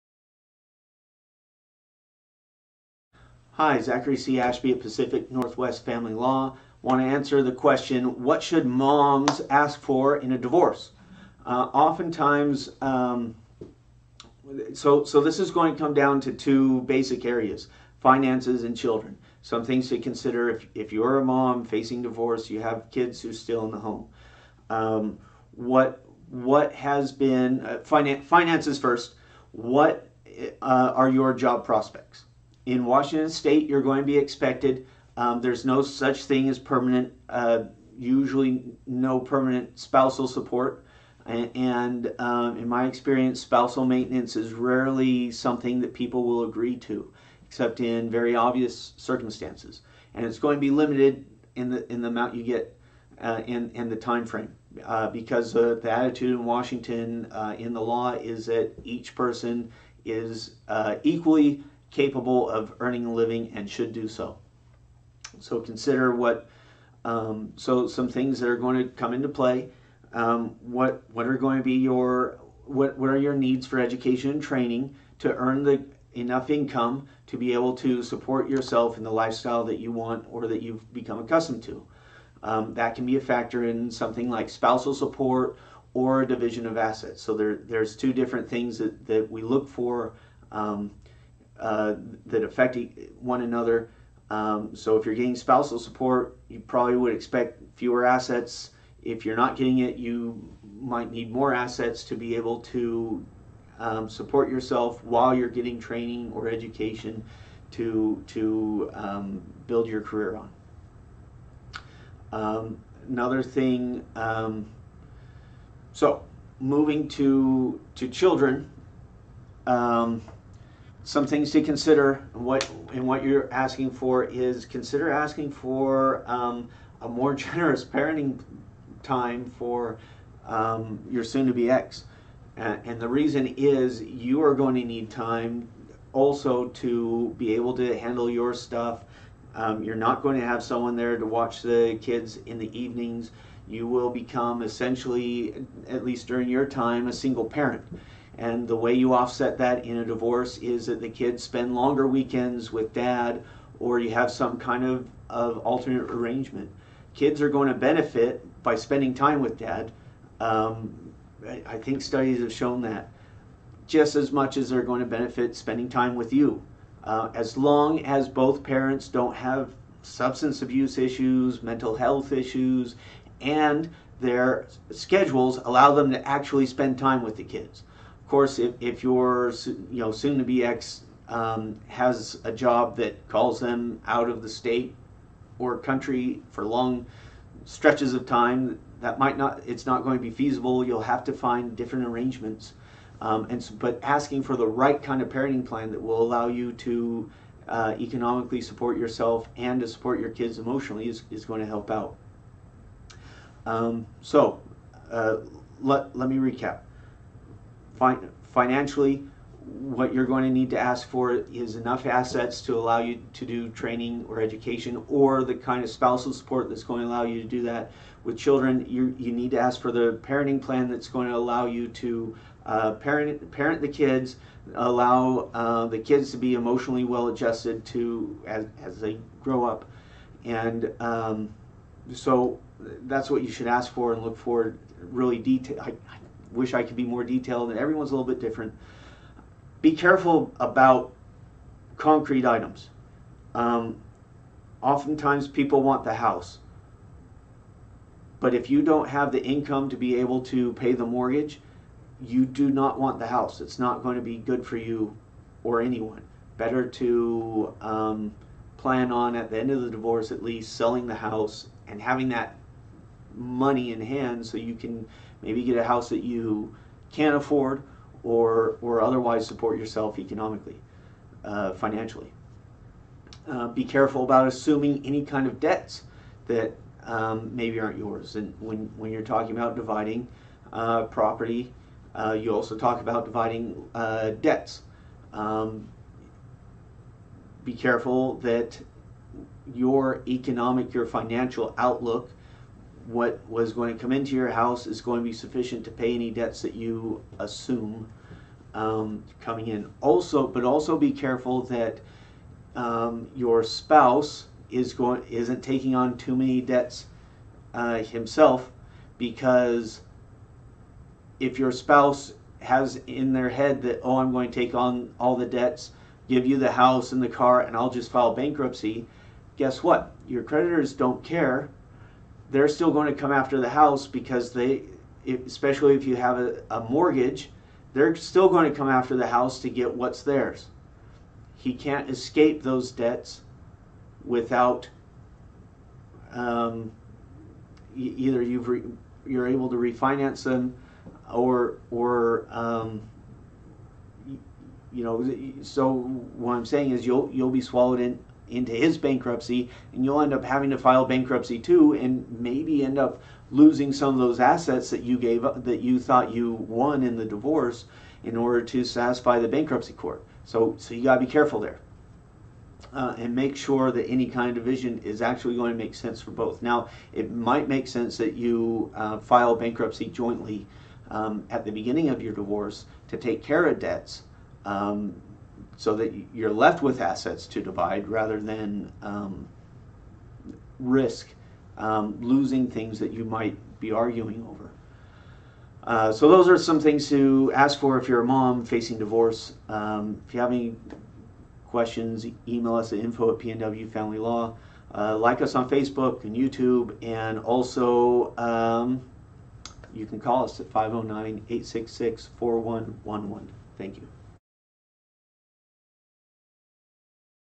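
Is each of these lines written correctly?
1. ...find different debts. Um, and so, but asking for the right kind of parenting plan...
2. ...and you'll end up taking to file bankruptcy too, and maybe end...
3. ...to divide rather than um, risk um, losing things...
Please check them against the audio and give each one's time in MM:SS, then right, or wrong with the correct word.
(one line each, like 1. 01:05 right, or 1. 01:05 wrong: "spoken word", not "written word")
1. 03:11 wrong: "arrangements", not "debts"
2. 05:49 wrong: "having", not "taking"
3. 06:17 right.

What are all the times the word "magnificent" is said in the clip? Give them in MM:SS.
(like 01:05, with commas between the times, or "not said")
not said.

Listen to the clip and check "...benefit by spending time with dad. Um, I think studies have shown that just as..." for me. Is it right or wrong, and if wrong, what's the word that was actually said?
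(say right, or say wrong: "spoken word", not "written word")
right.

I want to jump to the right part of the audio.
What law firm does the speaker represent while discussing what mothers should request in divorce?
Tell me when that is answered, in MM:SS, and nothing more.
00:04.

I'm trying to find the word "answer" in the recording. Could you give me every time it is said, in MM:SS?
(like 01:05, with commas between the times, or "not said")
00:07.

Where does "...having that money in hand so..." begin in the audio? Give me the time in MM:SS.
04:22.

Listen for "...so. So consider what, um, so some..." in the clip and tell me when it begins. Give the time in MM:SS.
01:04.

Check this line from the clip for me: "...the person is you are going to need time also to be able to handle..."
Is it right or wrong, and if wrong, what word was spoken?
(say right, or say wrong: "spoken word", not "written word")
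wrong: "reason", not "person".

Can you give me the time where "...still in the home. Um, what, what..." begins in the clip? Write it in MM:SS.
00:23.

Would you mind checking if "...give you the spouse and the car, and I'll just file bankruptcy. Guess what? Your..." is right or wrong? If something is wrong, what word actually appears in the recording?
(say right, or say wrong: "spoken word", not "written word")
wrong: "house", not "spouse".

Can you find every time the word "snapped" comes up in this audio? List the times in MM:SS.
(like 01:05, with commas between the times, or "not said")
not said.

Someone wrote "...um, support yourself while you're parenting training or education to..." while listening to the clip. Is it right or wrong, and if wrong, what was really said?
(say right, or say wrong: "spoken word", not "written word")
wrong: "getting", not "parenting".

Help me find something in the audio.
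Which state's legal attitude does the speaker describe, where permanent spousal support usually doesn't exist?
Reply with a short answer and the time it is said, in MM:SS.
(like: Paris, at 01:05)
Washington State, at 00:32.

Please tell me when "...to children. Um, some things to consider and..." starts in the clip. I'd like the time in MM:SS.
01:57.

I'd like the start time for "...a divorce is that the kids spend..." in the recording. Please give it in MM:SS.
02:29.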